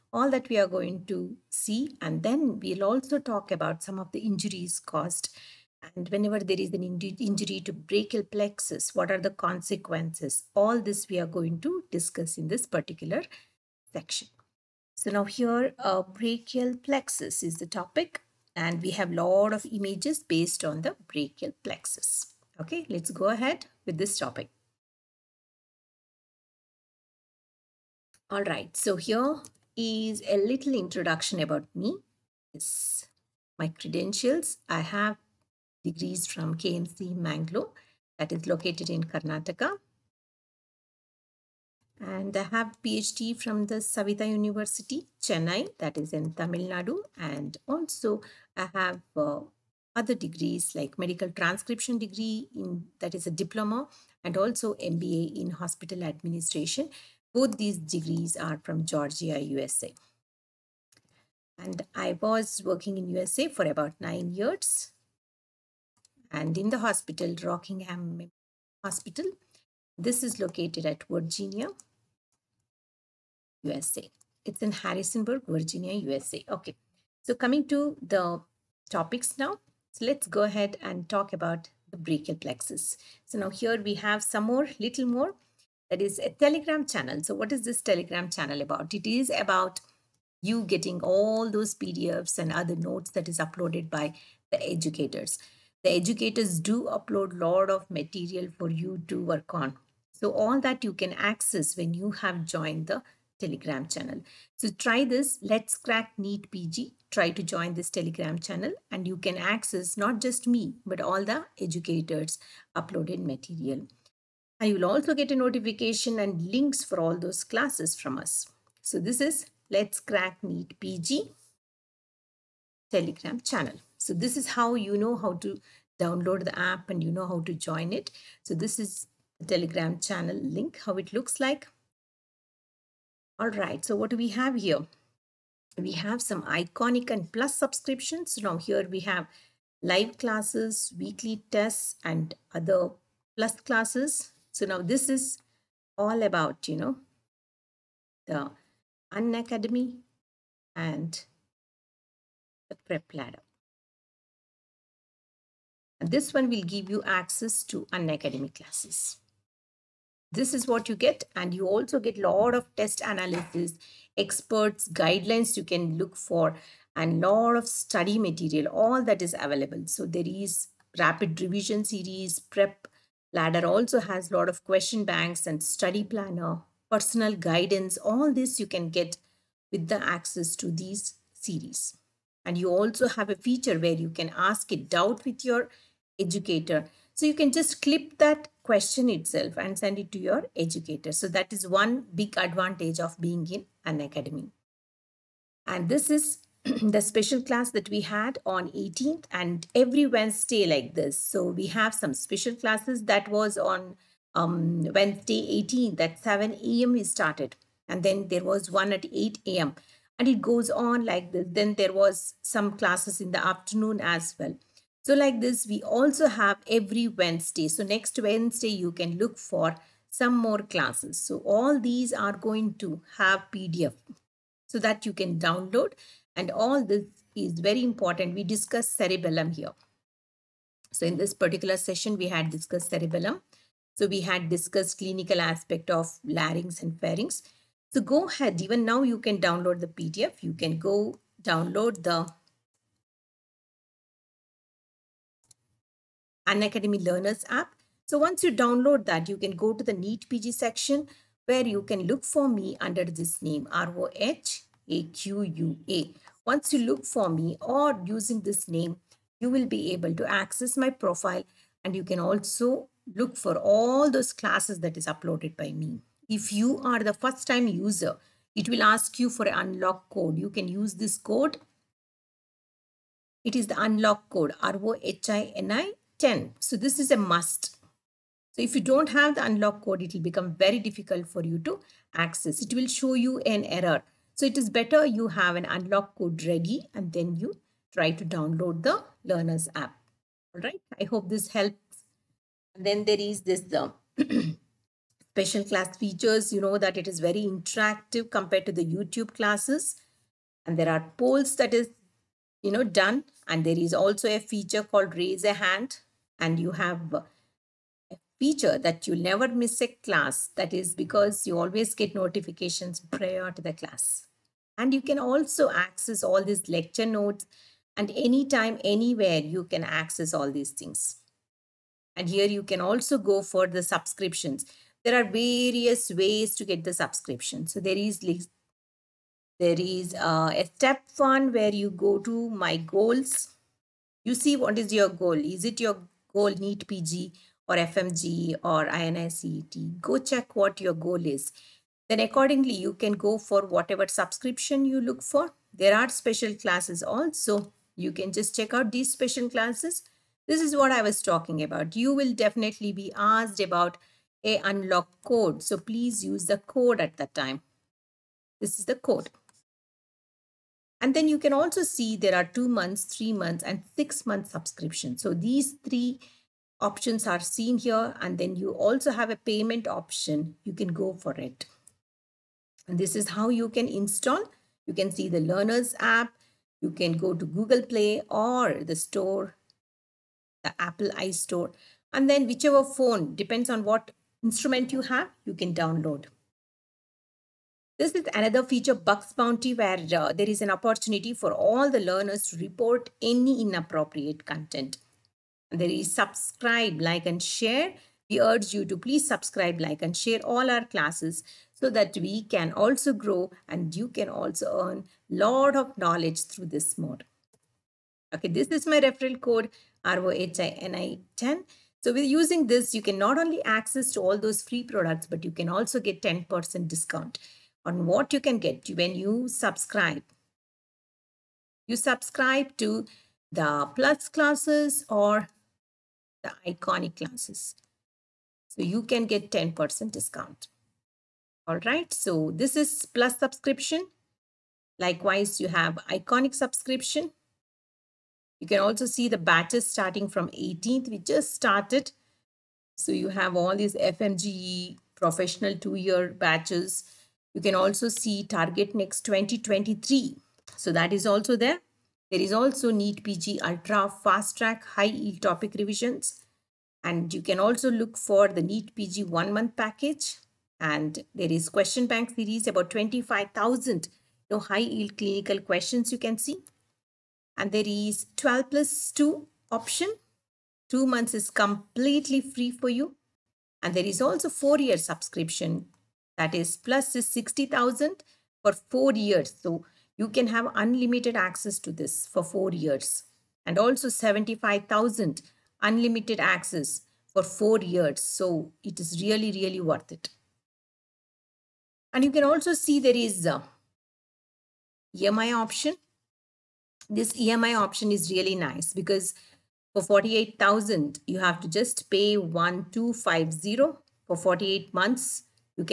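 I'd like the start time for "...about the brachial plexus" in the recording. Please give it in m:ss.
1:21.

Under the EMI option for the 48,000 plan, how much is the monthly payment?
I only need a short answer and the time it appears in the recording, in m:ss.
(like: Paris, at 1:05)
1250, at 8:22.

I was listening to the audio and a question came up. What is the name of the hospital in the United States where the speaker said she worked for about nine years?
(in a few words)
Rockingham Hospital.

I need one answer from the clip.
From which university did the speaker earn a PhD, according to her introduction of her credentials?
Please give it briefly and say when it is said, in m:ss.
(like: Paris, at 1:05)
Saveetha University, at 0:43.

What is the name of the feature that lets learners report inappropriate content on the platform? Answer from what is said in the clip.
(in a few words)
Bugs Bounty.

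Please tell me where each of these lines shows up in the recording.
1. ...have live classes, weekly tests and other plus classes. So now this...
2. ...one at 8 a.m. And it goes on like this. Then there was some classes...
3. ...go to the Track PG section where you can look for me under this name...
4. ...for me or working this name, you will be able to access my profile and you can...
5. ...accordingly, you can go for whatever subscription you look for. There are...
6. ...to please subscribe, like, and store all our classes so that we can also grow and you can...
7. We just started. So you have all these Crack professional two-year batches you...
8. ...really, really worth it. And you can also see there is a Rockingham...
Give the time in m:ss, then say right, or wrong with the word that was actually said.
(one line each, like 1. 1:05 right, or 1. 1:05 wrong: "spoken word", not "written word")
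1. 2:19 right
2. 3:28 right
3. 4:09 wrong: "NEET", not "Track"
4. 4:17 wrong: "using", not "working"
5. 5:42 right
6. 6:38 wrong: "share", not "store"
7. 7:21 wrong: "FMGE", not "Crack"
8. 8:09 wrong: "EMI", not "Rockingham".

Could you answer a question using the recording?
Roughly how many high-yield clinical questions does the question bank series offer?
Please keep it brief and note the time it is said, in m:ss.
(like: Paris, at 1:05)
25,000, at 7:42.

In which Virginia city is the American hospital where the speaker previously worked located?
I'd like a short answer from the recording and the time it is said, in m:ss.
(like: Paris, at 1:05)
Harrisonburg, at 1:14.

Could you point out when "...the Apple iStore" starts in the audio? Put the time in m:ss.
6:20.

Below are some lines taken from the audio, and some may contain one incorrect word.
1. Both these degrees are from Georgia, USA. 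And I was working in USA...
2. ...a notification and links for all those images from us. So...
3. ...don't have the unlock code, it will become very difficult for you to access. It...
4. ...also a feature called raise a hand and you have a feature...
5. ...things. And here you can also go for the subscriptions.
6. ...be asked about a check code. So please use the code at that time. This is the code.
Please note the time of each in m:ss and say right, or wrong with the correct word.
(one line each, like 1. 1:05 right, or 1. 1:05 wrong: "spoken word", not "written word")
1. 0:57 right
2. 1:55 wrong: "classes", not "images"
3. 4:38 right
4. 5:03 right
5. 5:20 right
6. 5:52 wrong: "unlock", not "check".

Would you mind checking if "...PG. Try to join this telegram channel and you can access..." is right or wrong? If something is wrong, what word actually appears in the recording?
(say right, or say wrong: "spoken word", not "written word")
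right.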